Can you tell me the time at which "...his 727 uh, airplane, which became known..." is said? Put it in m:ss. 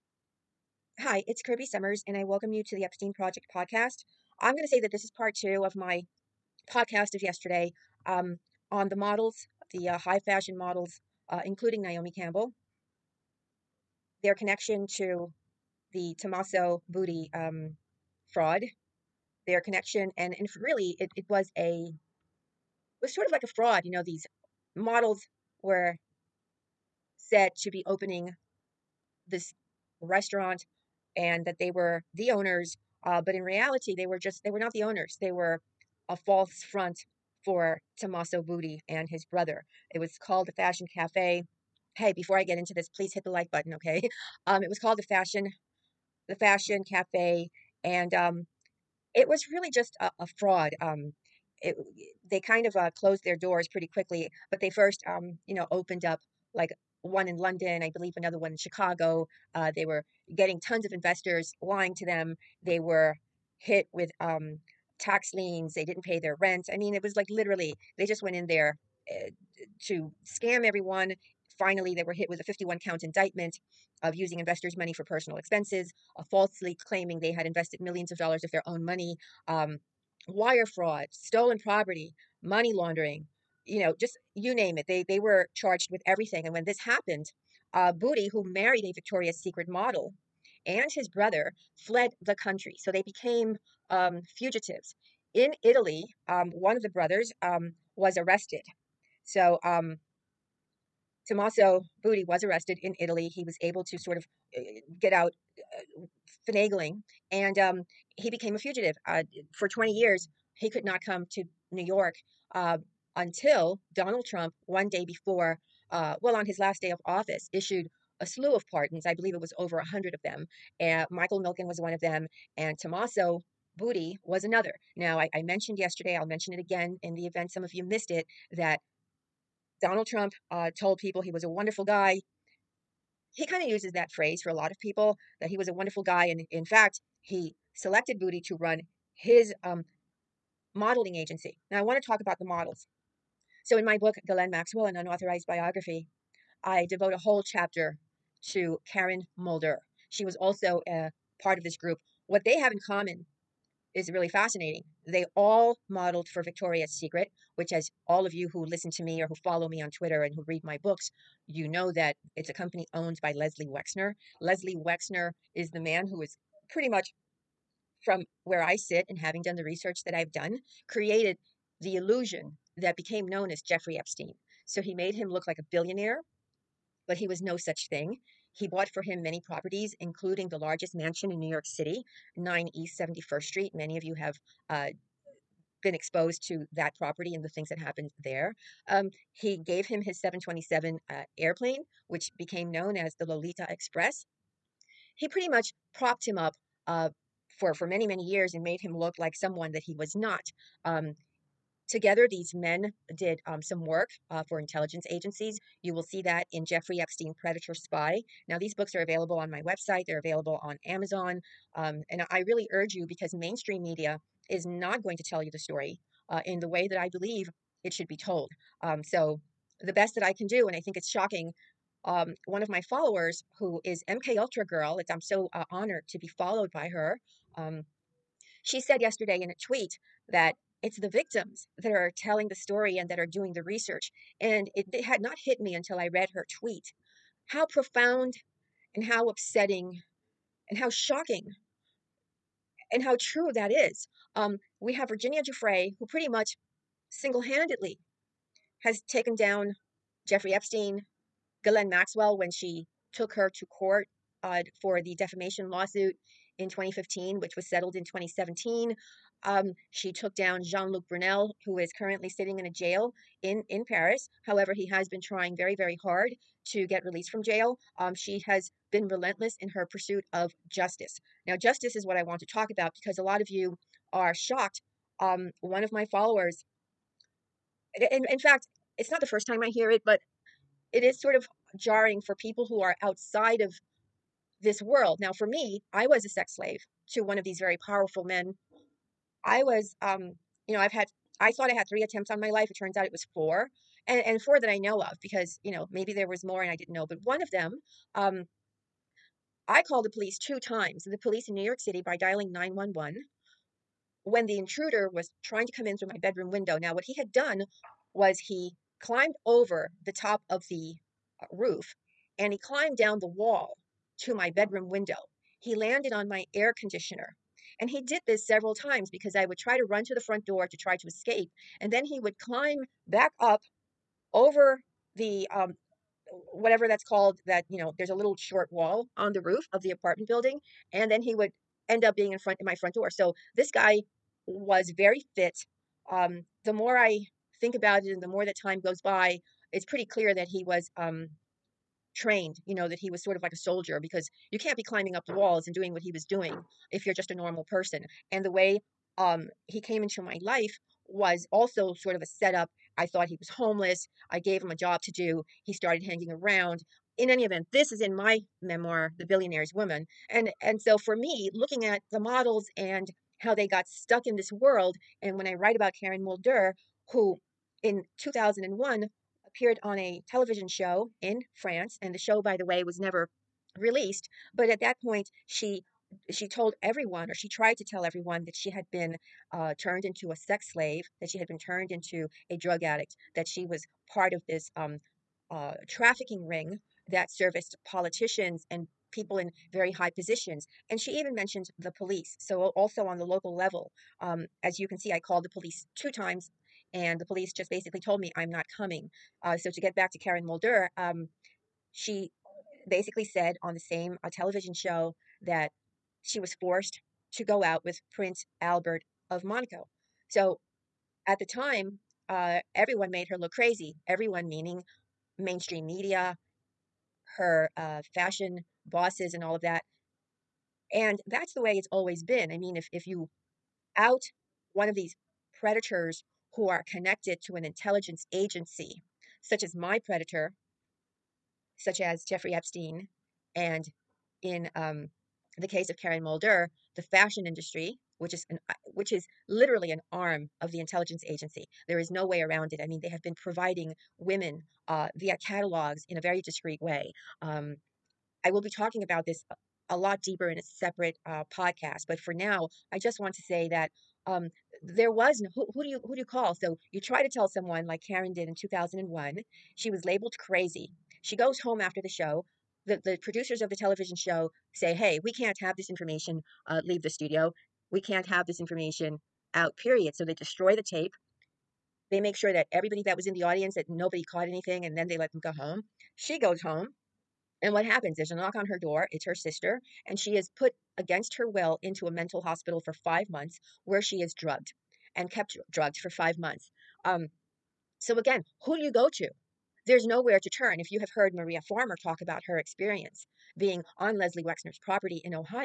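3:10.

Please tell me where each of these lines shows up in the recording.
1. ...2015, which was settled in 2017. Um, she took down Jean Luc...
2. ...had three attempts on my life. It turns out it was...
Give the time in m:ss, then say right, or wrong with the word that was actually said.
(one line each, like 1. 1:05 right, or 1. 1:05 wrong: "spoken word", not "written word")
1. 4:16 right
2. 4:51 right.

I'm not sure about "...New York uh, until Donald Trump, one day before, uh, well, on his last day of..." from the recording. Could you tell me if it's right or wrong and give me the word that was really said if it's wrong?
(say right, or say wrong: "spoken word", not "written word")
right.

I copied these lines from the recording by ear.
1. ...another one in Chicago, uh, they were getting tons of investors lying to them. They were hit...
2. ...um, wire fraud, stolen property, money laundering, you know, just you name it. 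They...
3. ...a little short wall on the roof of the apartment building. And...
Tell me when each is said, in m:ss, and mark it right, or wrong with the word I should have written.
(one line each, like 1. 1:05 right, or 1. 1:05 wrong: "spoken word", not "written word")
1. 0:58 right
2. 1:19 right
3. 5:28 right.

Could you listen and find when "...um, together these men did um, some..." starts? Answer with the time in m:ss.
3:20.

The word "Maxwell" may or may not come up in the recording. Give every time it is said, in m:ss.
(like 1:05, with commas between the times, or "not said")
2:24, 4:11.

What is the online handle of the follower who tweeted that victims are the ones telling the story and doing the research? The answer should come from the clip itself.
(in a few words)
MK Ultra Girl.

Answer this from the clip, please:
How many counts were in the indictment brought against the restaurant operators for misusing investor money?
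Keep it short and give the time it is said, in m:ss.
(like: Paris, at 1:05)
51, at 1:12.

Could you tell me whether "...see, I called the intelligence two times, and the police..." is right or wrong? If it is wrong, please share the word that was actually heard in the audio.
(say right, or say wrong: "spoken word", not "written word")
wrong: "police", not "intelligence".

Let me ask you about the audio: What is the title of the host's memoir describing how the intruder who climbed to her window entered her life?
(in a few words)
The Billionaire's Woman.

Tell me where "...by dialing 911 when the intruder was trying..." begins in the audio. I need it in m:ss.
5:02.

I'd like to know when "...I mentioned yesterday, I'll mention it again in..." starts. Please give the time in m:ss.
2:05.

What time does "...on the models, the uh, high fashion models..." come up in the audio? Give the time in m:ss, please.
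0:08.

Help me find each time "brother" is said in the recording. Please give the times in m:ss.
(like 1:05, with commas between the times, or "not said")
0:39, 1:31, 1:36.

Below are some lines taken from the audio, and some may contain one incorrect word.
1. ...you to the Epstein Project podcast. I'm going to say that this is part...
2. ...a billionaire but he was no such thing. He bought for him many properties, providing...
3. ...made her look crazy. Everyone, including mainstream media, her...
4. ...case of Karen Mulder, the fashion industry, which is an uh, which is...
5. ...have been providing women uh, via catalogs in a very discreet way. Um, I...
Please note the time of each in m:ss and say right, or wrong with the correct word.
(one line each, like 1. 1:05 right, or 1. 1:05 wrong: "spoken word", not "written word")
1. 0:02 right
2. 2:55 wrong: "including", not "providing"
3. 6:53 wrong: "meaning", not "including"
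4. 7:15 right
5. 7:23 right.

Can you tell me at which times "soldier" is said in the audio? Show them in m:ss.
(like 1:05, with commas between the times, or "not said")
5:43.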